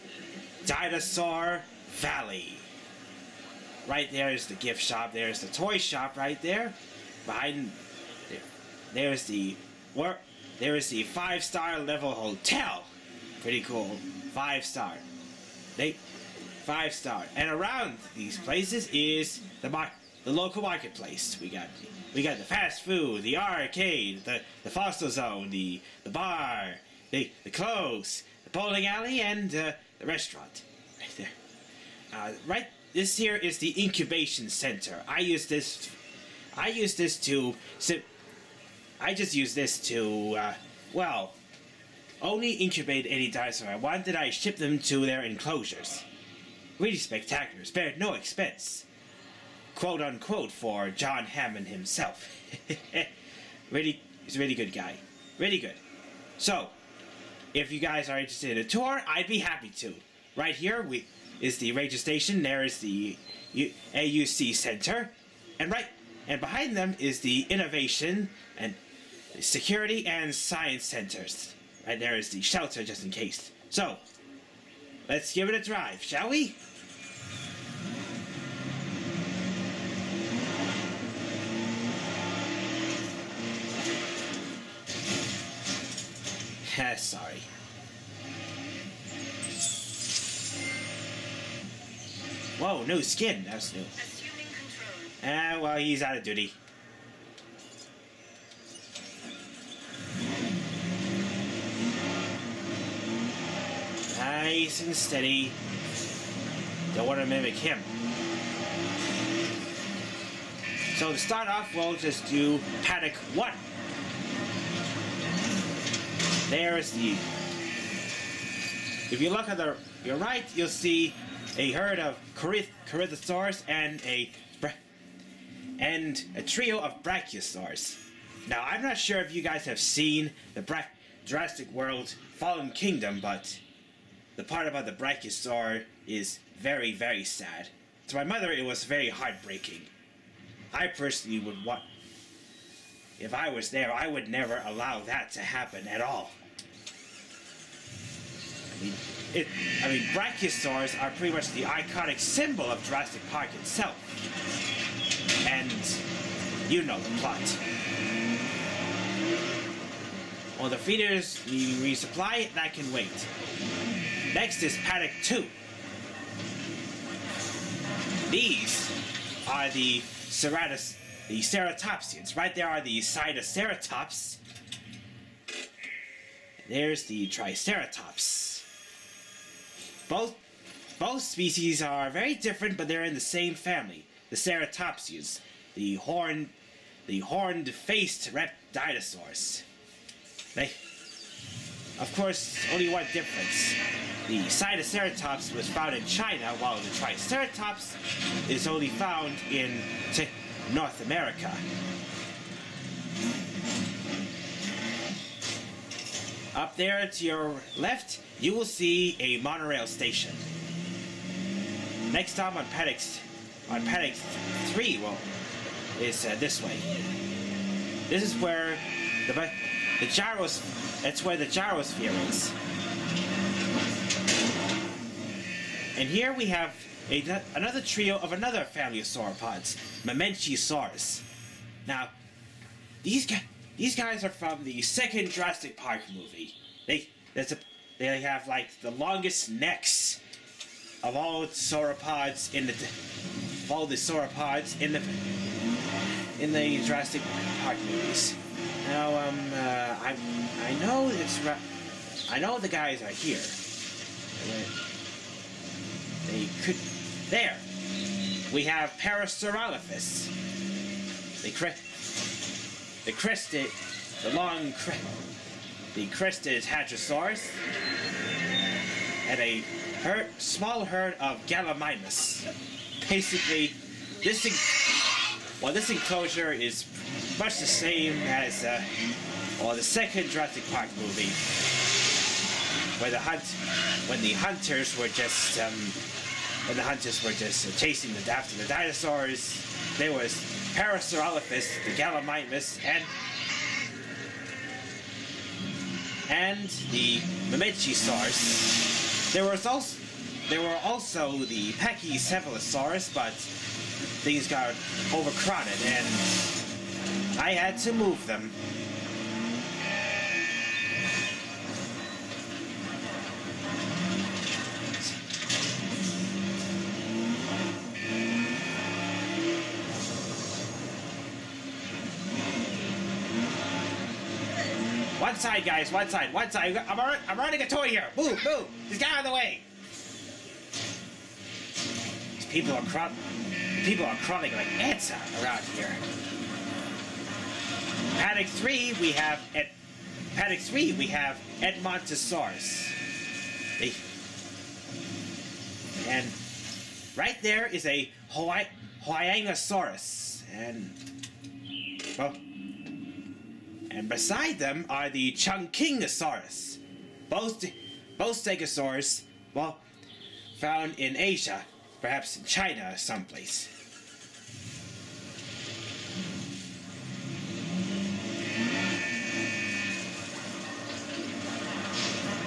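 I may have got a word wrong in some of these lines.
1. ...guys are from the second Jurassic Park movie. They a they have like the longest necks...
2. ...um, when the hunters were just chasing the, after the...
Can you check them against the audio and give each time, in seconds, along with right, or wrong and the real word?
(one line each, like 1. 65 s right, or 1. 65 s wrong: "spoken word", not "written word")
1. 233 s right
2. 285 s right.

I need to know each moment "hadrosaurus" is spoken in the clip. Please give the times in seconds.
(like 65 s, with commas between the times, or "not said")
266 s.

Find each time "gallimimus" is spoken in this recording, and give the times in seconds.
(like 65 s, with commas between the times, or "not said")
271 s, 291 s.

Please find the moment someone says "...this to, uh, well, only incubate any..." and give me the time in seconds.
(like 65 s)
39 s.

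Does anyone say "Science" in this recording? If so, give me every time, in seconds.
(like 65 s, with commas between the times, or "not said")
70 s.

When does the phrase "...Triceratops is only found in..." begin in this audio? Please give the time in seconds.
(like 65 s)
196 s.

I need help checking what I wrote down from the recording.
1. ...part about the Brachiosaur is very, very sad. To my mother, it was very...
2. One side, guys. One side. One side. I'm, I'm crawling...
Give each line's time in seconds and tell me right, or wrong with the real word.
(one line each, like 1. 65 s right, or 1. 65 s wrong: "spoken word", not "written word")
1. 134 s right
2. 325 s wrong: "running", not "crawling".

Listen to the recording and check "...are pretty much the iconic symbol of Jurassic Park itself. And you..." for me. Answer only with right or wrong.
right.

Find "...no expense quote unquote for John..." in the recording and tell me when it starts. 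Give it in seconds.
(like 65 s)
47 s.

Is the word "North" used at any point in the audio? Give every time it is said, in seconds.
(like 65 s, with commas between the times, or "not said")
200 s.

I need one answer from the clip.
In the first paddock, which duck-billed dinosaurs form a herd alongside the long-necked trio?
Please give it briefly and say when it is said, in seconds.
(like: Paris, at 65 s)
Corythosaurs, at 122 s.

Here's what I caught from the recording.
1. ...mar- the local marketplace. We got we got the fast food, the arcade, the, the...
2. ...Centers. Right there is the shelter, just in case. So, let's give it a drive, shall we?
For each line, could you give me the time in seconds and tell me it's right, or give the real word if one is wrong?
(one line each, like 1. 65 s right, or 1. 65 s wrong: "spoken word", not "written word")
1. 19 s right
2. 70 s right.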